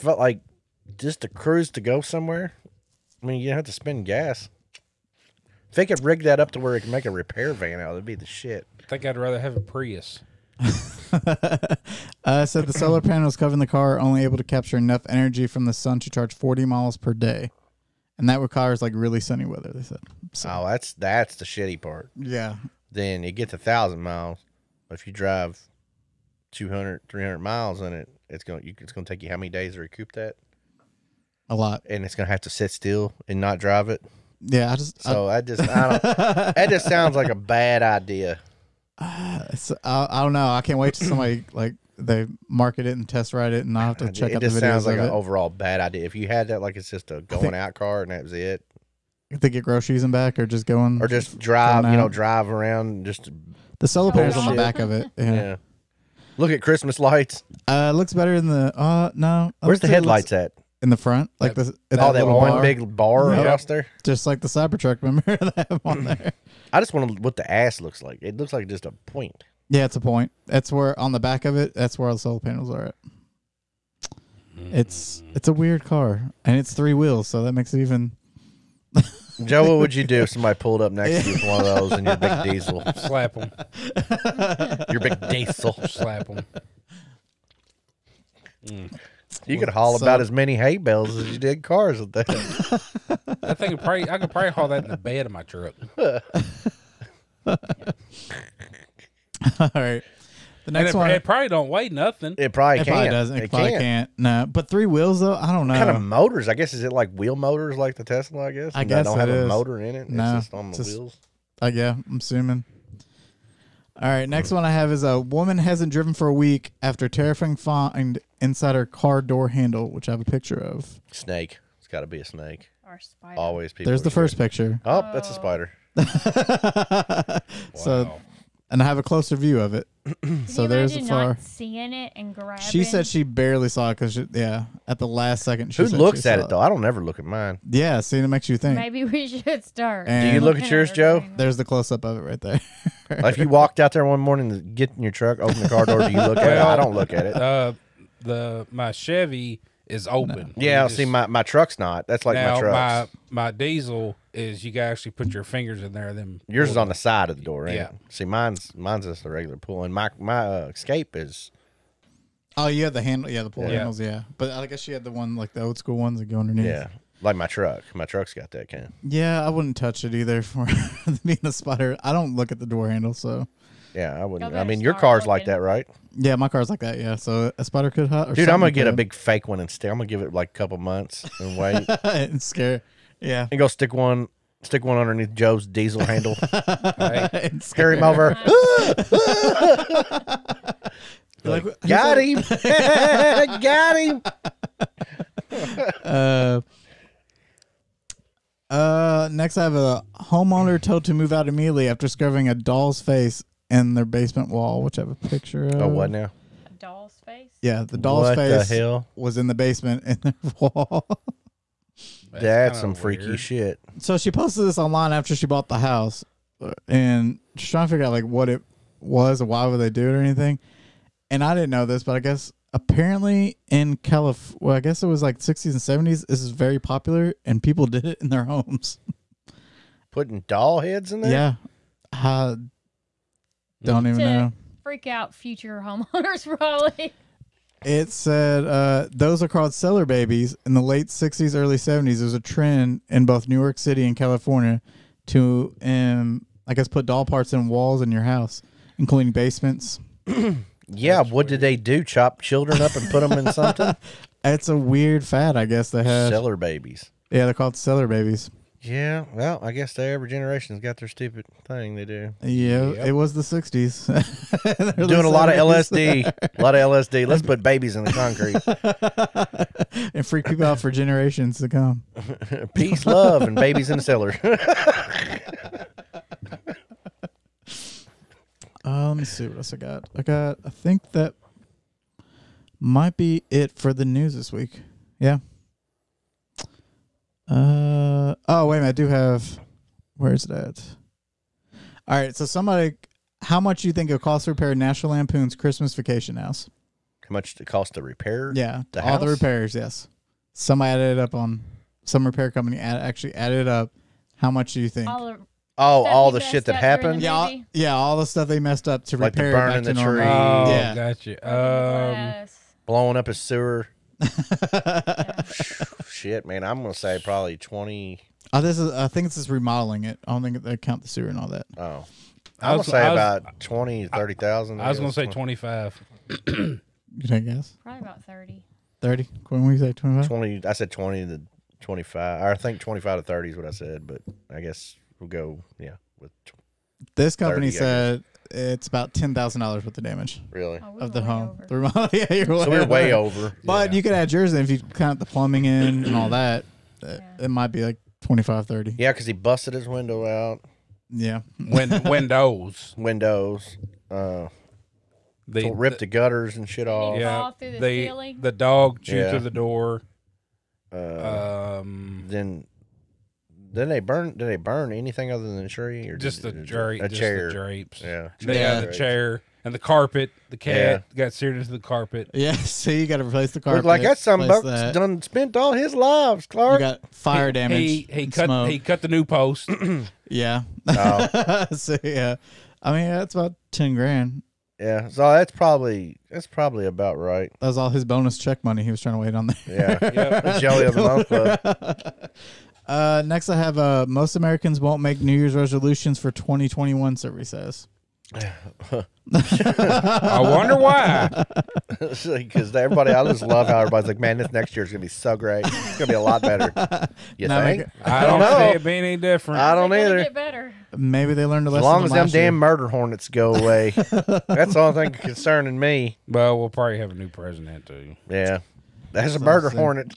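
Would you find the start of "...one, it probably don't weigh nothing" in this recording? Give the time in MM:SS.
01:40.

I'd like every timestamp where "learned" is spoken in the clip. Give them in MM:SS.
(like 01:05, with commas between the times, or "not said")
06:51.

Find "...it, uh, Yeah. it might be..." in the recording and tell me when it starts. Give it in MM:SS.
05:47.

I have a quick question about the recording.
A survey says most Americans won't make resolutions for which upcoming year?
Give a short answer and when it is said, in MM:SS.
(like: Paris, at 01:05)
2021, at 06:36.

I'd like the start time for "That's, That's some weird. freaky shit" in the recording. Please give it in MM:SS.
03:32.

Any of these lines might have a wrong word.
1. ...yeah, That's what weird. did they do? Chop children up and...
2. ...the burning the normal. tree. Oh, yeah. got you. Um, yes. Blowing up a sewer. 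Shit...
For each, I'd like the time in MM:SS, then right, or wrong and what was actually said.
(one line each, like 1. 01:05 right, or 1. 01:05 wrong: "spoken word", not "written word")
1. 04:10 right
2. 05:09 right.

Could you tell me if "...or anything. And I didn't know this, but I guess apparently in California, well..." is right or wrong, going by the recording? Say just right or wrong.
right.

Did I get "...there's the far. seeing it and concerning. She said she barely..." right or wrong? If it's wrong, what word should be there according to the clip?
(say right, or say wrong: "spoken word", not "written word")
wrong: "grabbing", not "concerning".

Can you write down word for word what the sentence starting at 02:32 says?
My my diesel is you gotta actually put your fingers in there.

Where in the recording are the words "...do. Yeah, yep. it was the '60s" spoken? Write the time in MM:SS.
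04:22.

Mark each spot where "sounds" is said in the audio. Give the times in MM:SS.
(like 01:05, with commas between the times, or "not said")
00:36, 00:44.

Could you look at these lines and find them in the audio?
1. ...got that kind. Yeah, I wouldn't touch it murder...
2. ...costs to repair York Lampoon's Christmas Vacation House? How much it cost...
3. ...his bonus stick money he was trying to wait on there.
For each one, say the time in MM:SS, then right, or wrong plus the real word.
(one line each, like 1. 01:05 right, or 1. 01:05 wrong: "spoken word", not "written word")
1. 02:48 wrong: "either", not "murder"
2. 04:54 wrong: "National", not "York"
3. 06:27 wrong: "check", not "stick".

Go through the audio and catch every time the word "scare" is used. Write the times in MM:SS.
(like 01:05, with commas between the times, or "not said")
03:02, 03:07.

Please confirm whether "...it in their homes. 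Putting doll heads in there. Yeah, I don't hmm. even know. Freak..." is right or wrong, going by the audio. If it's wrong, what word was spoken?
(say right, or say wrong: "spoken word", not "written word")
right.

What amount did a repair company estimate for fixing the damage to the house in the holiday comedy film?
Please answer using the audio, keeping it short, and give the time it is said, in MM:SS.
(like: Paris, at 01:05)
$10,000, at 05:39.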